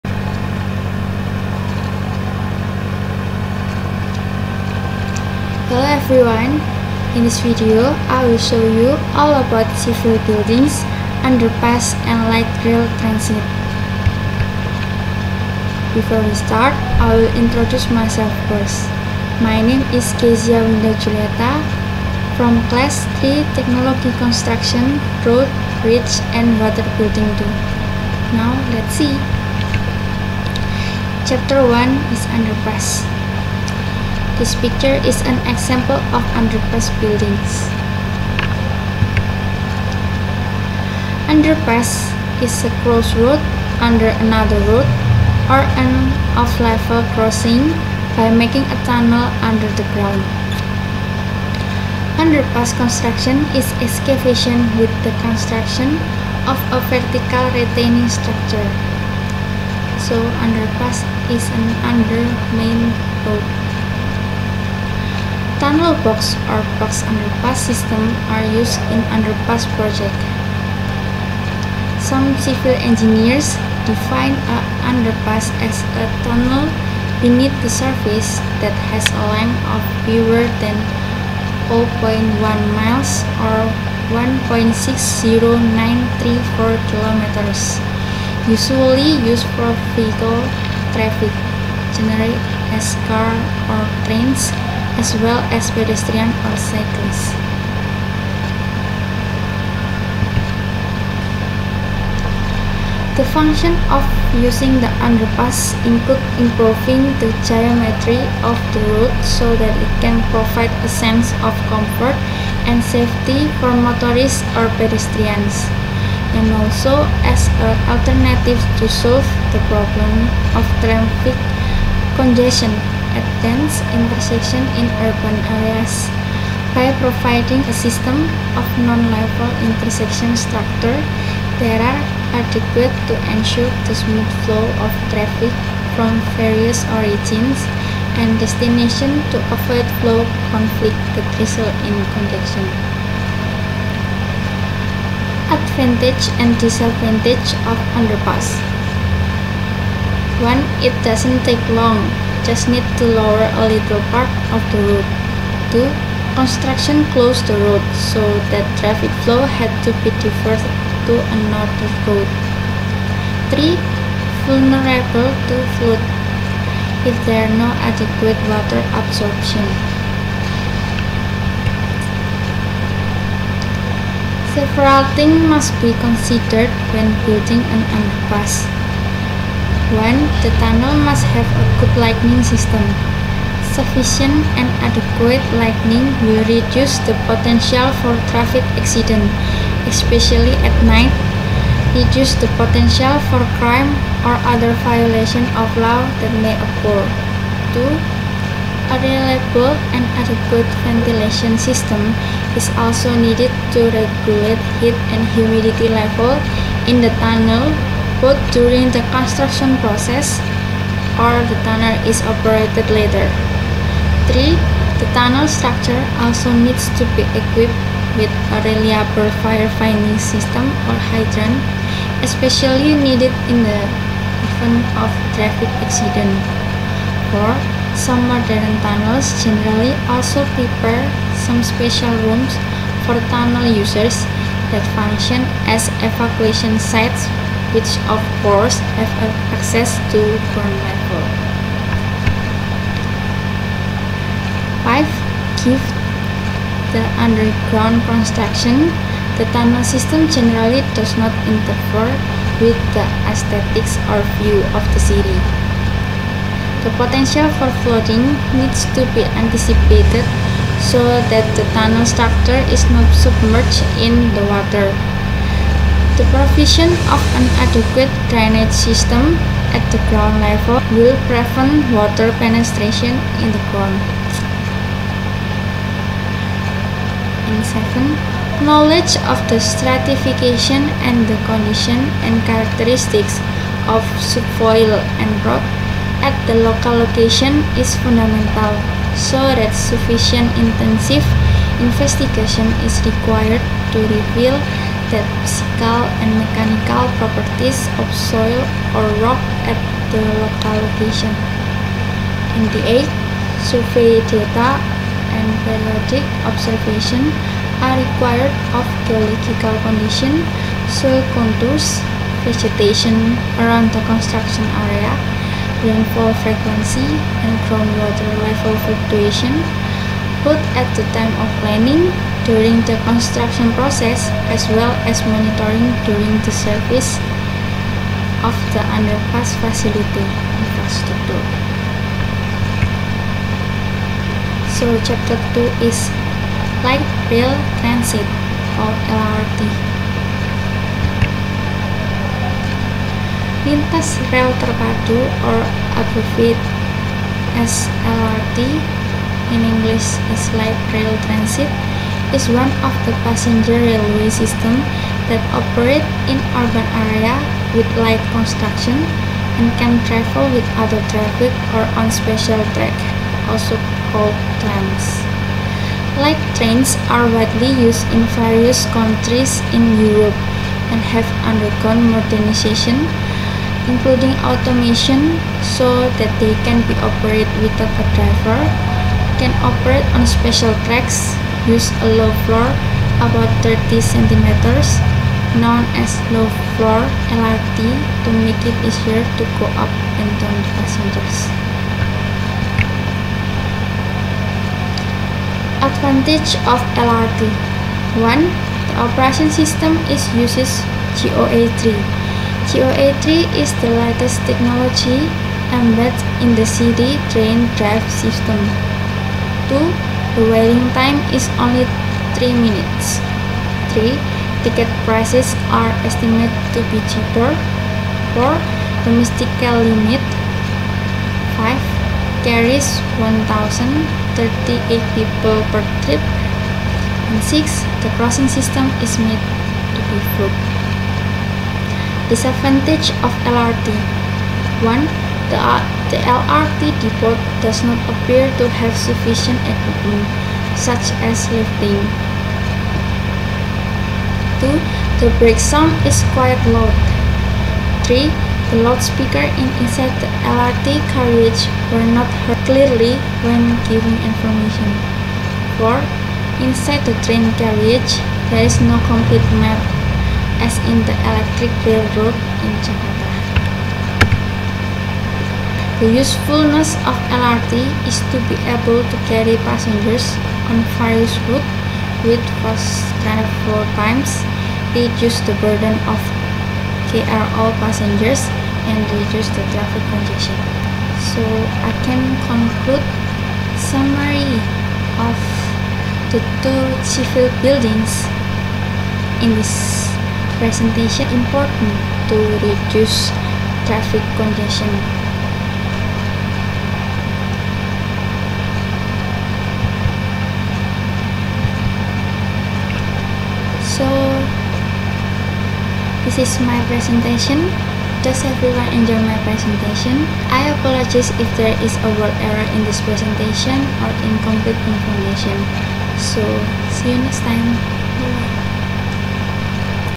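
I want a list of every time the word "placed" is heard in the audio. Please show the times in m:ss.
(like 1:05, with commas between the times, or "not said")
not said.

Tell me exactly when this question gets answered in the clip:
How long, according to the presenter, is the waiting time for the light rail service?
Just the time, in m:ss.
6:52.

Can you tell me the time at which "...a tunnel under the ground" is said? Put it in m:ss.
0:48.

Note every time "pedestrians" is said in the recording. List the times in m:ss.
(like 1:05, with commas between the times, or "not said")
1:35, 1:54.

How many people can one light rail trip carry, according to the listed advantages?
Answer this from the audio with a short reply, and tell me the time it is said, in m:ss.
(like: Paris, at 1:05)
1,038, at 7:03.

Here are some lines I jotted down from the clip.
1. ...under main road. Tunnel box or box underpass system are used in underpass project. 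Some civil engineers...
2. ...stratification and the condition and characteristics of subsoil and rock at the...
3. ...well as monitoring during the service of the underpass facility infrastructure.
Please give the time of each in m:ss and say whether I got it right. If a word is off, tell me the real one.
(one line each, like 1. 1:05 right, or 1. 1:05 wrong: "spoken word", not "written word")
1. 1:01 right
2. 4:39 right
3. 5:24 right.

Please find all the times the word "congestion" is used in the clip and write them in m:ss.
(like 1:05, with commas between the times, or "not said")
2:02, 2:22, 8:00, 8:14.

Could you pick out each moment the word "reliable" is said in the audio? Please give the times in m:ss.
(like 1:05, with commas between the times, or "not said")
3:18, 3:38.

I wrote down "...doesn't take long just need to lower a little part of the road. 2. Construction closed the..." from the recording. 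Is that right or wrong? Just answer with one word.
right.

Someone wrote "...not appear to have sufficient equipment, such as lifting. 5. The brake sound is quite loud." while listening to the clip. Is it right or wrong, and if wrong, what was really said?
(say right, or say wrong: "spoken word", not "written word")
wrong: "2", not "5".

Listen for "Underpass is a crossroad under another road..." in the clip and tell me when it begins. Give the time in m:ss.
0:41.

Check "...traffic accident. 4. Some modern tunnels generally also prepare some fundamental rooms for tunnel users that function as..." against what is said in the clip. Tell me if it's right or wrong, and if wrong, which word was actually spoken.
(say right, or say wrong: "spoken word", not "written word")
wrong: "special", not "fundamental".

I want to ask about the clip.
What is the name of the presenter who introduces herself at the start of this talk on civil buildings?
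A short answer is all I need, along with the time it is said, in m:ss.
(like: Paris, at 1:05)
Kezia Winda Julieta, at 0:20.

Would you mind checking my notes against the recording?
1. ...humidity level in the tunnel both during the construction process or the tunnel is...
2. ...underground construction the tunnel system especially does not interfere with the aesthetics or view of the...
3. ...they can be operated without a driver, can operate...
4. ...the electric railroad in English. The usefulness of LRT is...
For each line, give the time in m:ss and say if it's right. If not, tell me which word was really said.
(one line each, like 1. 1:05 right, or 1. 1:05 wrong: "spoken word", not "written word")
1. 3:25 right
2. 4:07 wrong: "generally", not "especially"
3. 6:16 right
4. 7:41 wrong: "Jakarta", not "English".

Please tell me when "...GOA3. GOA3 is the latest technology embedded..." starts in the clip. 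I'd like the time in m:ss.
6:41.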